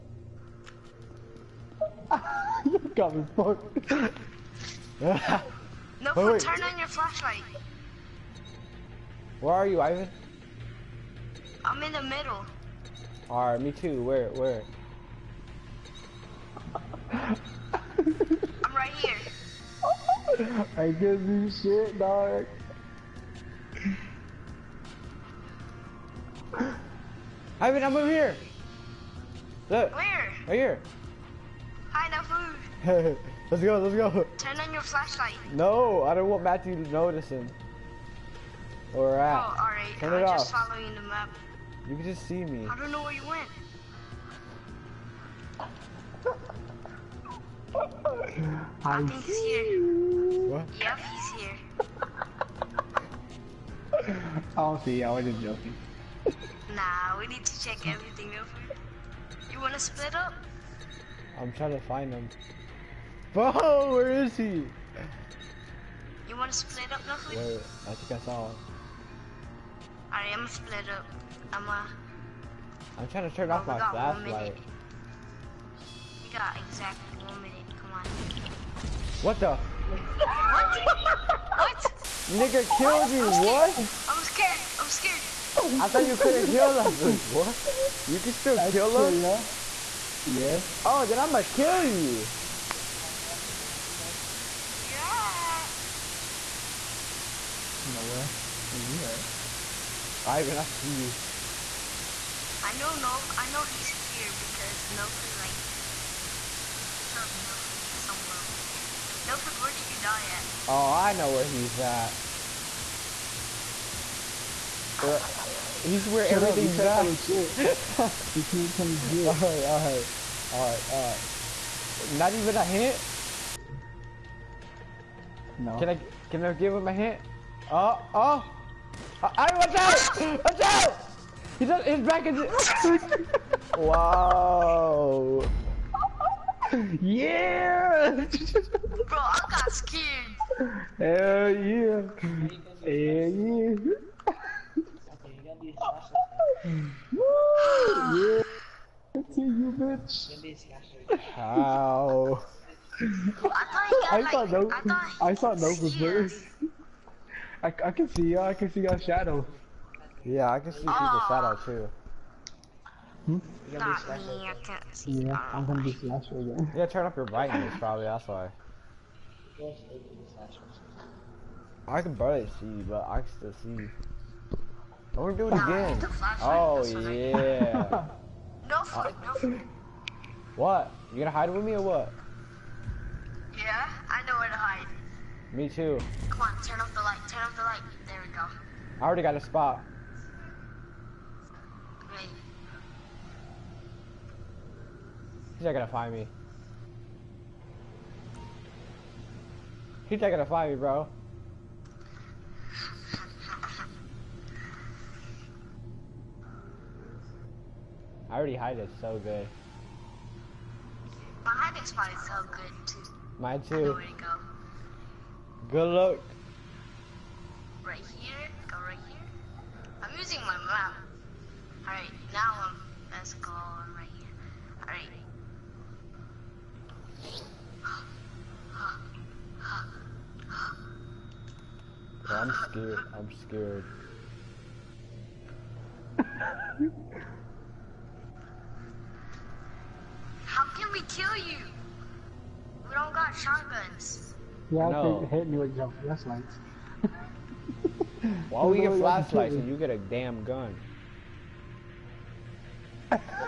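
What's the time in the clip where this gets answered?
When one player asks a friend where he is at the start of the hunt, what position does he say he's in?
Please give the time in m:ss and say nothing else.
0:11.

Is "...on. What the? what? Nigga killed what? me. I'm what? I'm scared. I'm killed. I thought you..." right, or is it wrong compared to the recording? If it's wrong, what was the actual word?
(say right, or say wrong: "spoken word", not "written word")
wrong: "scared", not "killed".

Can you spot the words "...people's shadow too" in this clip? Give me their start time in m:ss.
2:40.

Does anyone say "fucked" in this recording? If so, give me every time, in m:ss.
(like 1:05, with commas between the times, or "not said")
0:03.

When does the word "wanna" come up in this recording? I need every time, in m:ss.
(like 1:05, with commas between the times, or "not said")
0:59, 1:06.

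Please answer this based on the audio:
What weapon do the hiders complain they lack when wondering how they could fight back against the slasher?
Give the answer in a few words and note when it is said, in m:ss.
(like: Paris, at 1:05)
Shotguns, at 4:03.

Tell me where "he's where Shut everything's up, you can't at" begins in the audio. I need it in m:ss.
1:55.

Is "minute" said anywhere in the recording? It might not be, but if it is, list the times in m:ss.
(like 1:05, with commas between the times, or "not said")
1:17.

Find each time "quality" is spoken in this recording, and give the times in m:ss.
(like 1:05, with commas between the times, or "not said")
not said.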